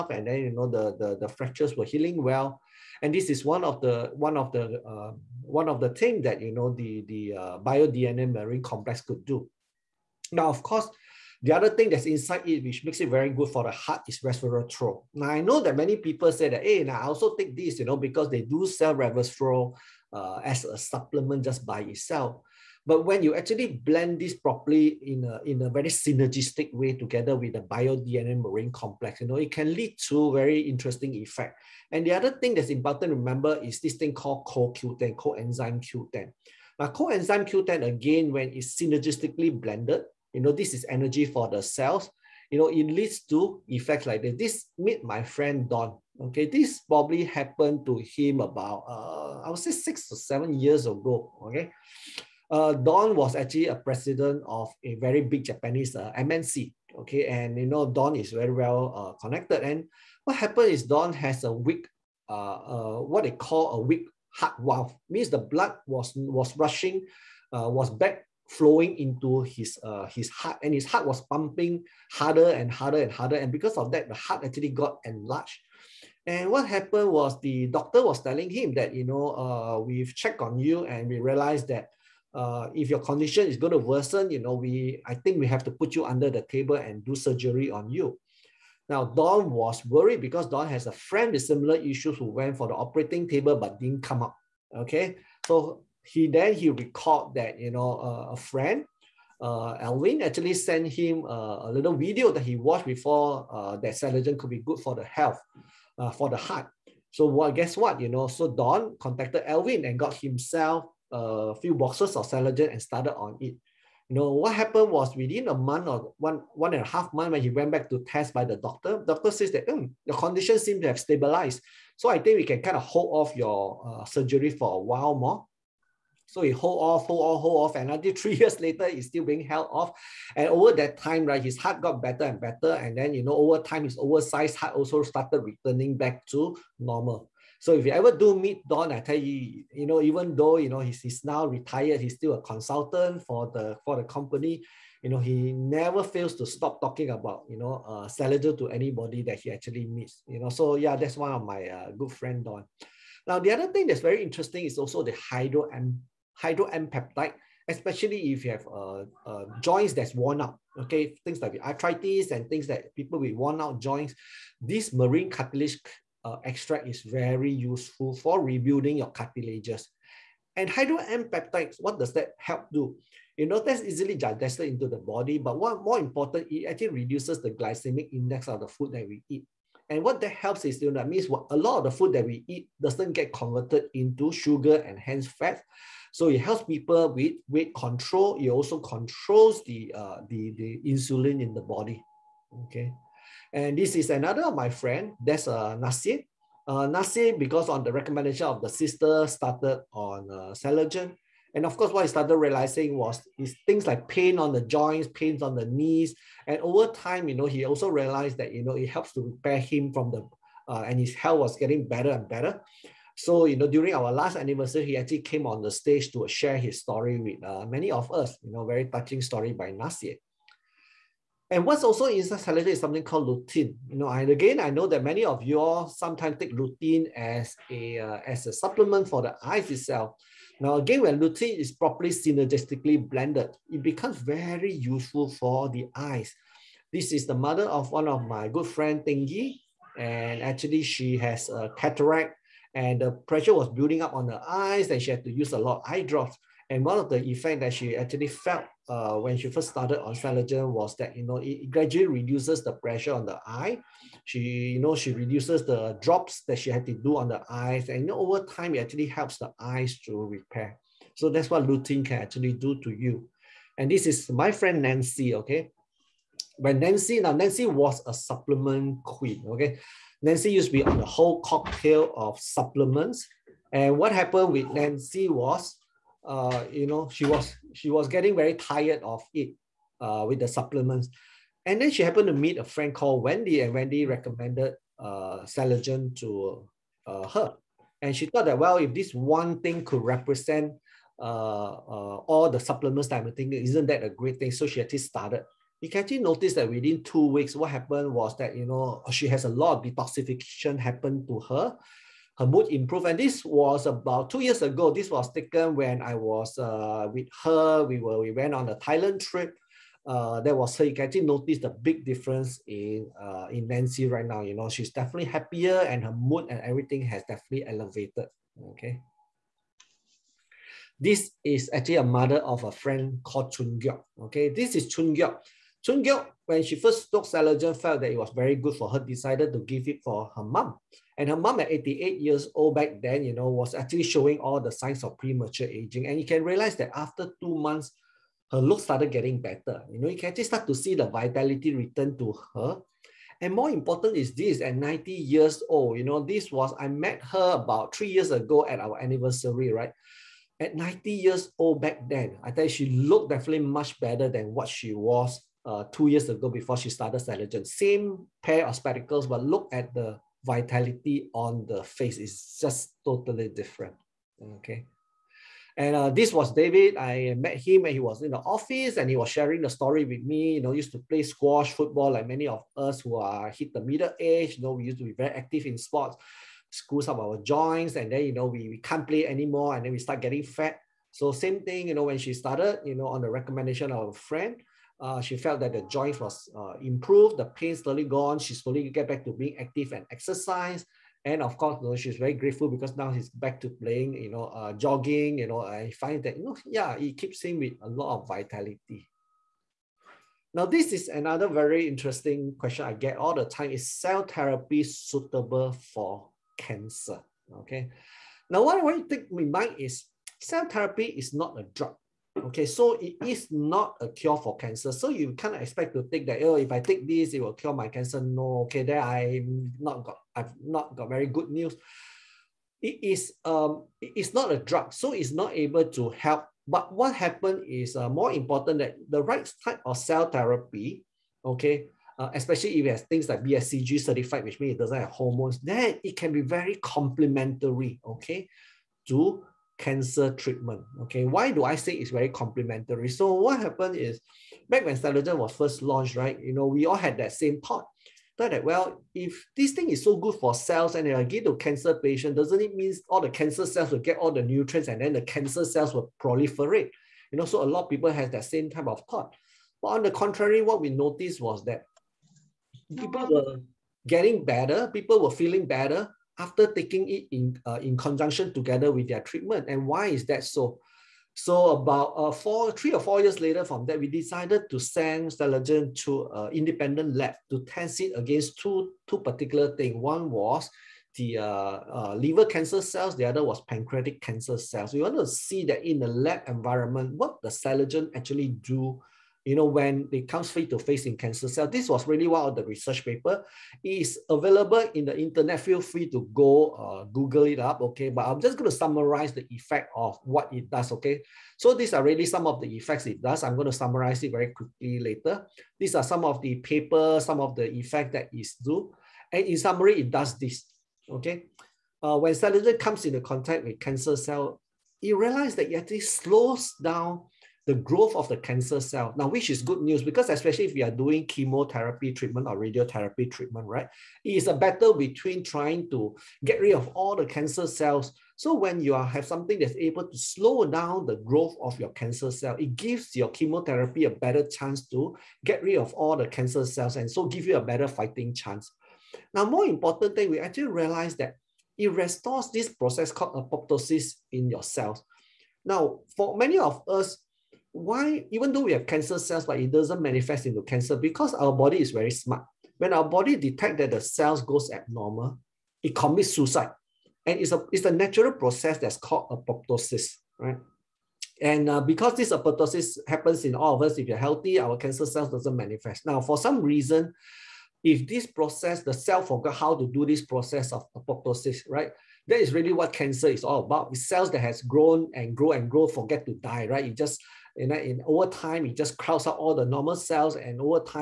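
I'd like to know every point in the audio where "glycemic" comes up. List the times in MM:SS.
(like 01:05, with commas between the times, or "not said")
02:57.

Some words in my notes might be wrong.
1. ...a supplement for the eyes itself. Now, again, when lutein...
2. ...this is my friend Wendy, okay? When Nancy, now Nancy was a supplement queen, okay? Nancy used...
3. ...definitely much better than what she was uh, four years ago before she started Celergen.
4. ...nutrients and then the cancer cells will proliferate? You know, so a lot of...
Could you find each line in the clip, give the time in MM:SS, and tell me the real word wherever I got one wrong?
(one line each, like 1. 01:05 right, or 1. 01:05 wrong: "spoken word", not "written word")
1. 03:48 right
2. 04:23 wrong: "Nancy", not "Wendy"
3. 05:53 wrong: "two", not "four"
4. 07:34 right.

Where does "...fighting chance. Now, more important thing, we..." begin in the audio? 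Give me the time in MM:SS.
08:57.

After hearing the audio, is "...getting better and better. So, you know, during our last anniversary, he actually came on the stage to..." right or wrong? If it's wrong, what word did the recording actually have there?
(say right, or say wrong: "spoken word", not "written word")
right.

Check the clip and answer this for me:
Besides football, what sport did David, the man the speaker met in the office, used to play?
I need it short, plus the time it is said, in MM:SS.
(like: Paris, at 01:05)
squash, at 06:11.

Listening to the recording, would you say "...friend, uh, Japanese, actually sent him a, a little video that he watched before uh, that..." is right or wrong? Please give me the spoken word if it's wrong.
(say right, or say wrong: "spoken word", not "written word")
wrong: "Alvin", not "Japanese".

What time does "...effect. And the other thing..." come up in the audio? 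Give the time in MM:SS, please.
00:31.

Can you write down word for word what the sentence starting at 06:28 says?
She slowly get back to being active and exercise.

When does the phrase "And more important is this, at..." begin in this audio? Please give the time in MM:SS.
05:43.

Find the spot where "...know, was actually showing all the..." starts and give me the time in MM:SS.
05:33.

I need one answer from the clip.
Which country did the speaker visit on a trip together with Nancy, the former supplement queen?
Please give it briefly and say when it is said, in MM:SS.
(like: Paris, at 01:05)
Thailand, at 05:08.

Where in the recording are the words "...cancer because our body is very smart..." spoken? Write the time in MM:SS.
09:10.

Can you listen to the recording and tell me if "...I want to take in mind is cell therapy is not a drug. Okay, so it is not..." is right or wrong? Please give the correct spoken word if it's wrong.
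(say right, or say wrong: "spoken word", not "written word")
right.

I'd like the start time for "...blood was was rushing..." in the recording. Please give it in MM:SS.
01:05.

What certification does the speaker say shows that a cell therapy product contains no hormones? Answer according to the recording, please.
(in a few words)
BSCG certified.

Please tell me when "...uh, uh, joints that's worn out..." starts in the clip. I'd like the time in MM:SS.
02:38.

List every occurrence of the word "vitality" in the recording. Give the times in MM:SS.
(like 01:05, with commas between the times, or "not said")
05:41, 06:00, 06:38.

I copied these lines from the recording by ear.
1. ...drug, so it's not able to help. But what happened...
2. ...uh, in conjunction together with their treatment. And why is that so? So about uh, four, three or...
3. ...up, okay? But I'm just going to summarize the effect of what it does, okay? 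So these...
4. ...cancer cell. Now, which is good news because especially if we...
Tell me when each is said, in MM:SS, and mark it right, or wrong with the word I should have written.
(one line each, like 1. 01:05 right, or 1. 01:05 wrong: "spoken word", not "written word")
1. 07:04 right
2. 07:47 right
3. 08:17 right
4. 08:38 right.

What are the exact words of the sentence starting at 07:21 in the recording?
Okay, why do I say it's very complementary?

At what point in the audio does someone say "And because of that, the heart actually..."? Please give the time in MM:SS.
01:13.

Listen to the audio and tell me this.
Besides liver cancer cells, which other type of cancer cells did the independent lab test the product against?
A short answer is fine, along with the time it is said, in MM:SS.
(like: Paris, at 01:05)
pancreatic, at 08:03.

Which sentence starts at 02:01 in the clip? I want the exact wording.
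So I think we can kind of hold off your uh, surgery for a while more.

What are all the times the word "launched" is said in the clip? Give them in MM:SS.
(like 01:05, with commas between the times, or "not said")
07:25.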